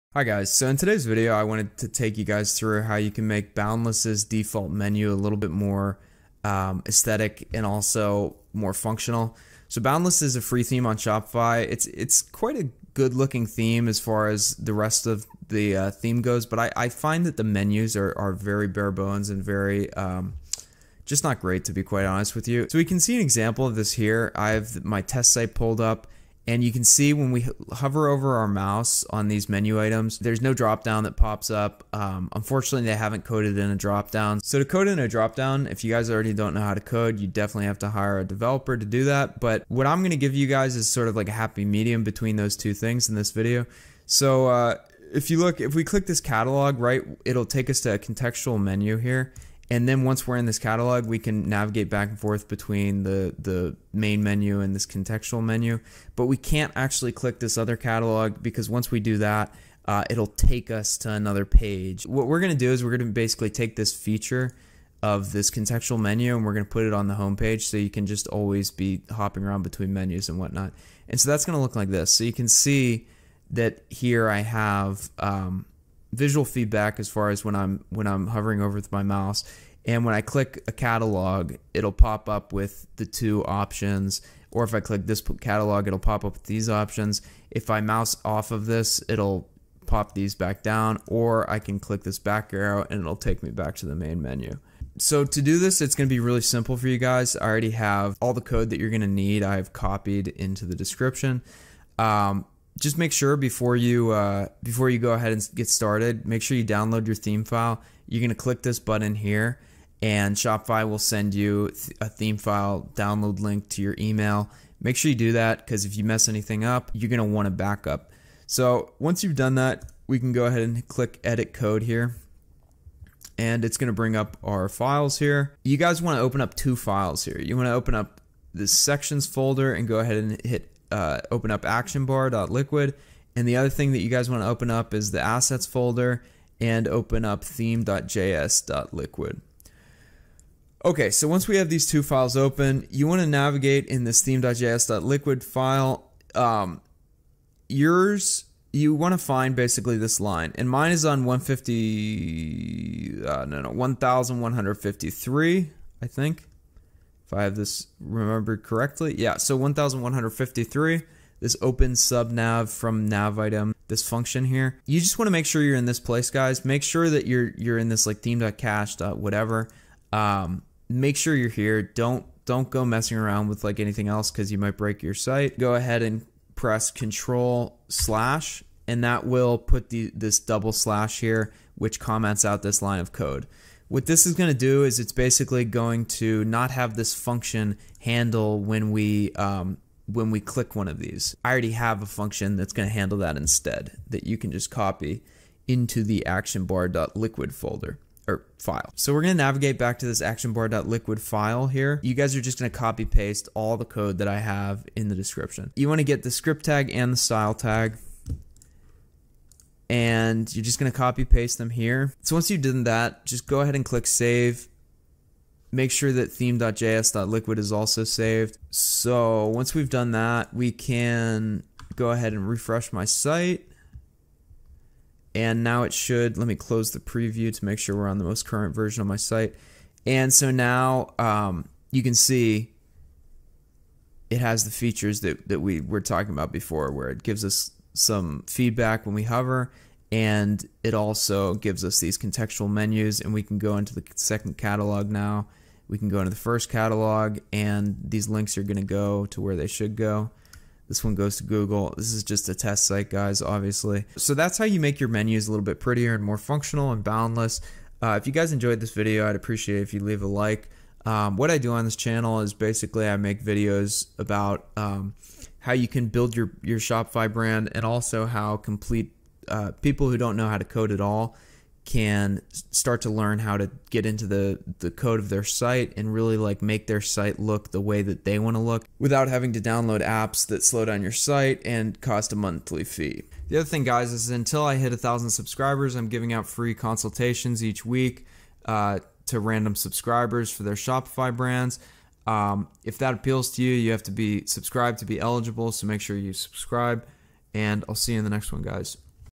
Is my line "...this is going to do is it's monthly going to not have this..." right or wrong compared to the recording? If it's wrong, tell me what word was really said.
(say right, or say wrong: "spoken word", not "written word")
wrong: "basically", not "monthly".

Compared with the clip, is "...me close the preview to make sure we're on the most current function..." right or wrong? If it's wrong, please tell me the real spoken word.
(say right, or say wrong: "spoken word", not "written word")
wrong: "version", not "function".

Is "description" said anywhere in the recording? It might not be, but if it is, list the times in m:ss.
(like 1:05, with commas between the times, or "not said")
1:40, 3:25.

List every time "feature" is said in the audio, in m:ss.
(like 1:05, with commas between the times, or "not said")
1:03, 3:54.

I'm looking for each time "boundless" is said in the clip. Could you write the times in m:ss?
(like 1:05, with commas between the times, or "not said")
0:03, 0:09, 4:17.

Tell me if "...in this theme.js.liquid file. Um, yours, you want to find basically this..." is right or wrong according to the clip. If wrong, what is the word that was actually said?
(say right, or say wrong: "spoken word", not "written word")
right.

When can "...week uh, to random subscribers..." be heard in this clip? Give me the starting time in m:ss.
4:47.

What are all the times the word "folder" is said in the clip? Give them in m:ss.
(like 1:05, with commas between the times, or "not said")
2:09, 2:15, 3:17.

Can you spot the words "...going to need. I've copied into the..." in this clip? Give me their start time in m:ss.
1:38.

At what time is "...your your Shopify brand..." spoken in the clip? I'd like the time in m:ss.
4:26.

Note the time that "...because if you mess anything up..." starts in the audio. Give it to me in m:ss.
1:55.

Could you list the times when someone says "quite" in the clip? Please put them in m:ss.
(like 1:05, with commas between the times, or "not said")
0:12, 0:21.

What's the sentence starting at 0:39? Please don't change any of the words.
But what I'm gonna give you guys is sort of like a happy medium between those two things in this video.